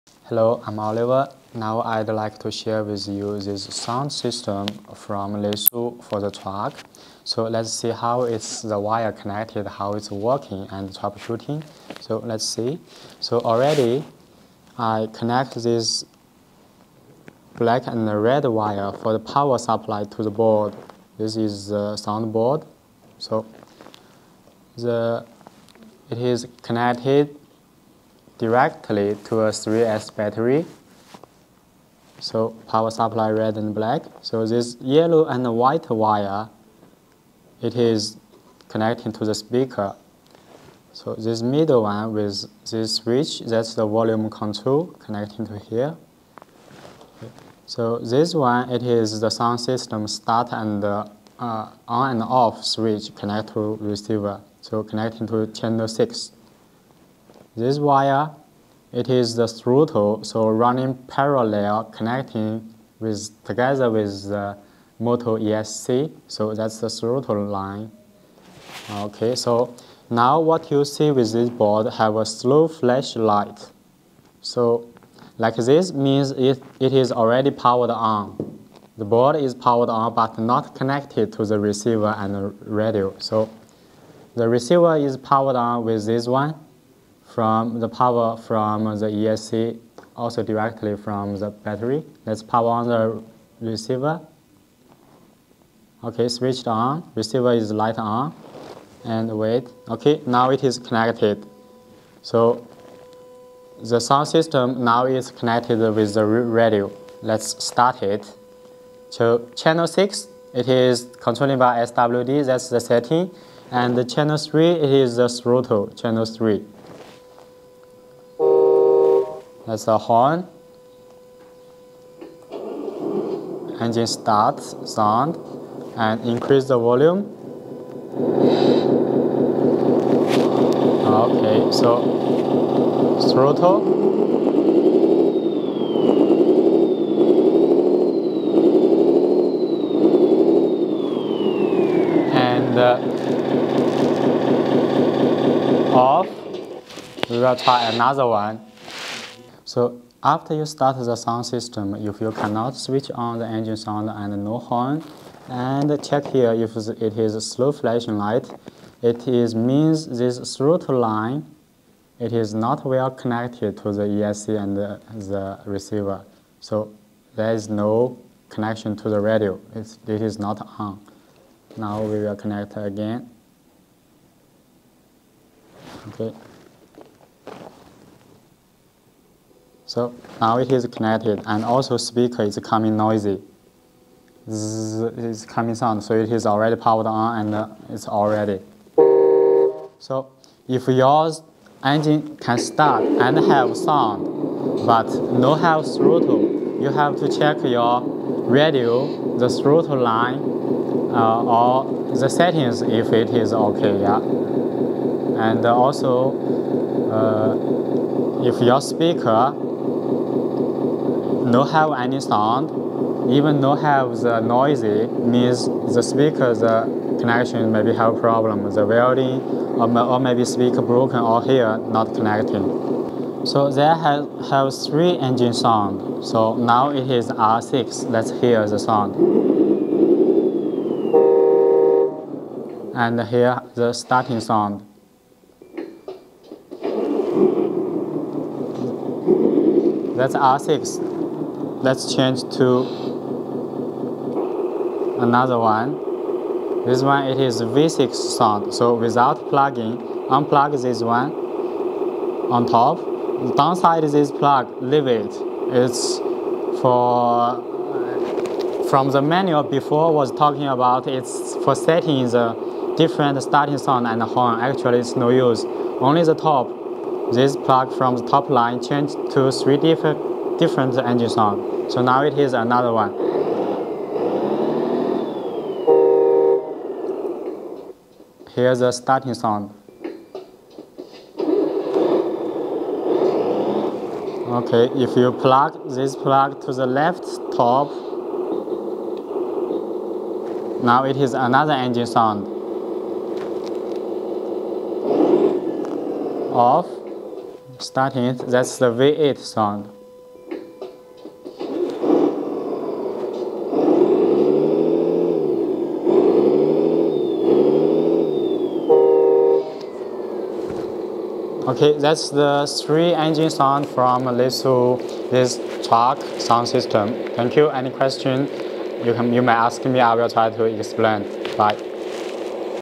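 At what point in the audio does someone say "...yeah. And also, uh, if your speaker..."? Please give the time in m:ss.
3:23.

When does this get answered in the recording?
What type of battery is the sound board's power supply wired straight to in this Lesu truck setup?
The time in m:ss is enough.
0:29.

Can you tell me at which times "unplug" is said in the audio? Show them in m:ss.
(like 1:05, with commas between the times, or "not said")
4:10.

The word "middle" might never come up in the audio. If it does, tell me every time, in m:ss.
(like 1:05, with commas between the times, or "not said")
0:41.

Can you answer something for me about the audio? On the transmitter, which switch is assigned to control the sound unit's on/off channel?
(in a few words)
SWD.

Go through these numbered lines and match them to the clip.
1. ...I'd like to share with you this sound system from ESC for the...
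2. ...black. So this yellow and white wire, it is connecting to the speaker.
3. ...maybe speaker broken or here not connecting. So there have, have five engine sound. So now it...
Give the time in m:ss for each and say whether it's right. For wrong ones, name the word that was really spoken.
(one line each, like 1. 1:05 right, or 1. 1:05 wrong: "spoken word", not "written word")
1. 0:01 wrong: "Lesu", not "ESC"
2. 0:33 right
3. 3:40 wrong: "three", not "five".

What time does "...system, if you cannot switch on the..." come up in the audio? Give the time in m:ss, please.
2:31.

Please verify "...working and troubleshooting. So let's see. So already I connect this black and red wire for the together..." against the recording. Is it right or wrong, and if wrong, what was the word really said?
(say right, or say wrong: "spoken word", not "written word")
wrong: "power", not "together".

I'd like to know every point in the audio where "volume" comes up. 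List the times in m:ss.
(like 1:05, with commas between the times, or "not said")
0:43, 2:06.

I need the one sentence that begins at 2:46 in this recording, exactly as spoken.
So there is no connection to the radio.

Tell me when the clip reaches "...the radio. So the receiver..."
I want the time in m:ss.
1:22.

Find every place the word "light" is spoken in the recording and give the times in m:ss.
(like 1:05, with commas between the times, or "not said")
1:13, 1:37, 2:38.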